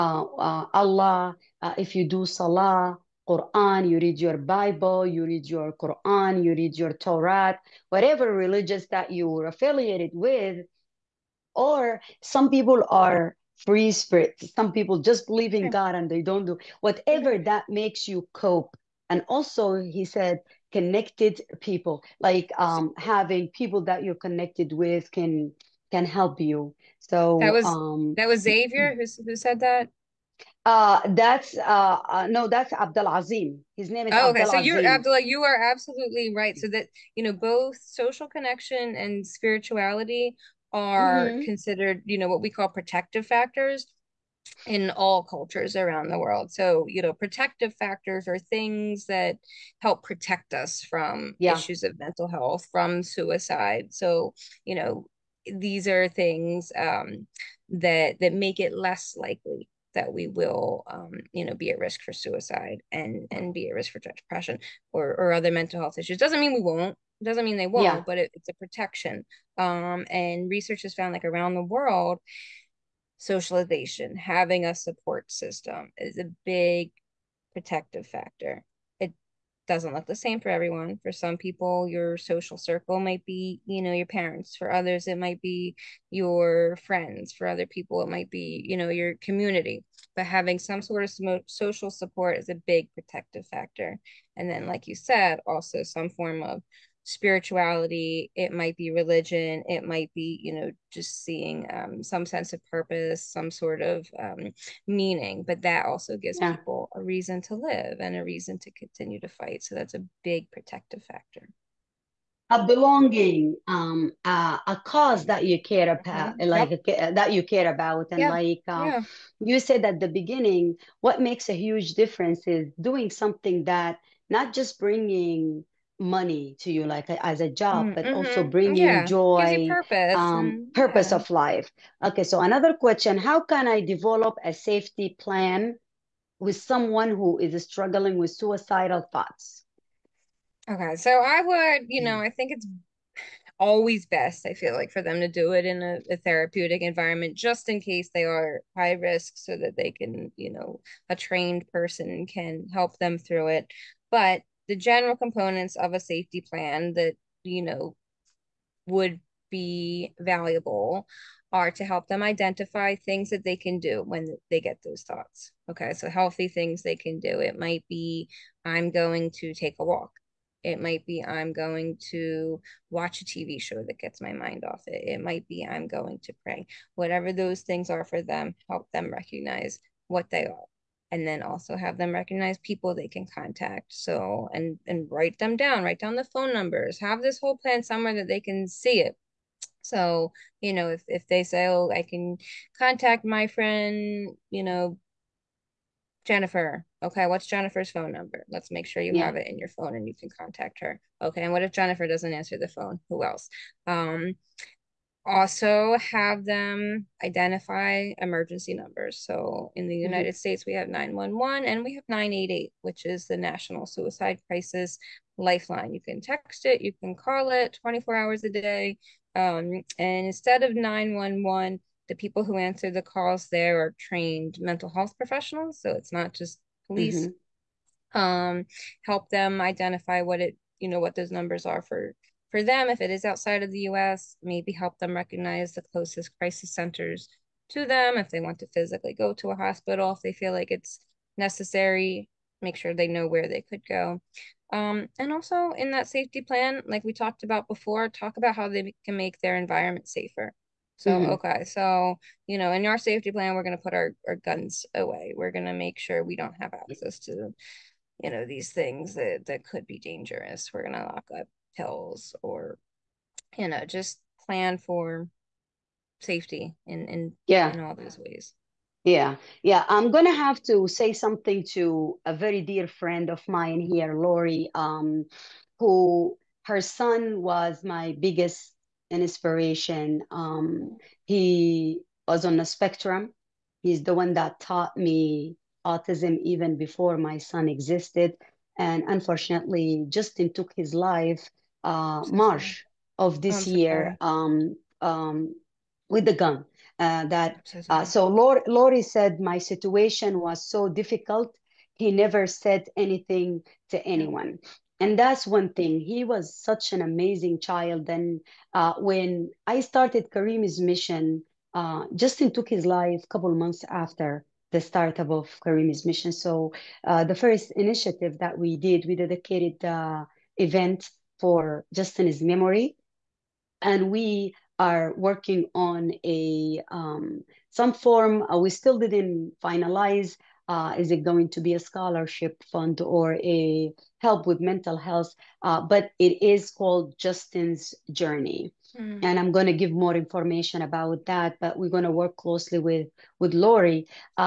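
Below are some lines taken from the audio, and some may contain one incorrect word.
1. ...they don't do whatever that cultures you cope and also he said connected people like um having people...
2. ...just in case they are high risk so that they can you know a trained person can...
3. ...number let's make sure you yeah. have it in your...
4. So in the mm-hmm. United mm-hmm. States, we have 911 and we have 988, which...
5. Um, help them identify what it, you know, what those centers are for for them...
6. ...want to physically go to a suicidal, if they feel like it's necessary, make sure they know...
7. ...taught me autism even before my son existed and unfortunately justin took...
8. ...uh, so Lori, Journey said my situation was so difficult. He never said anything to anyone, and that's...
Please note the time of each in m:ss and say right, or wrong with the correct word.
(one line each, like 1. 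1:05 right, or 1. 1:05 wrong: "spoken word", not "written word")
1. 0:16 wrong: "makes", not "cultures"
2. 2:27 right
3. 3:18 right
4. 3:29 right
5. 3:48 wrong: "numbers", not "centers"
6. 3:58 wrong: "hospital", not "suicidal"
7. 4:44 right
8. 4:57 wrong: "Lori", not "Journey".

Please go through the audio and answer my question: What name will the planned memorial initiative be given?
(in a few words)
Justin's Journey.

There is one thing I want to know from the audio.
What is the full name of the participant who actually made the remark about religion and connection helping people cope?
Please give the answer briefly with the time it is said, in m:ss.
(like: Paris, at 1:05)
Abdul Azim, at 0:32.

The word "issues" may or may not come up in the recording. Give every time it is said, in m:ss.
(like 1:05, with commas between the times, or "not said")
0:51, 1:05.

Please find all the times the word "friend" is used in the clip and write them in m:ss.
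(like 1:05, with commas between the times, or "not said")
1:26, 3:13, 4:32.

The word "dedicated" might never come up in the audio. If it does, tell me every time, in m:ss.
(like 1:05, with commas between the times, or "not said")
5:19.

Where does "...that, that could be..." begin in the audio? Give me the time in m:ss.
4:19.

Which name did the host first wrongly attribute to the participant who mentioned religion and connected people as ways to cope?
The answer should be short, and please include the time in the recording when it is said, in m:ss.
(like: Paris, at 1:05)
Xavier, at 0:28.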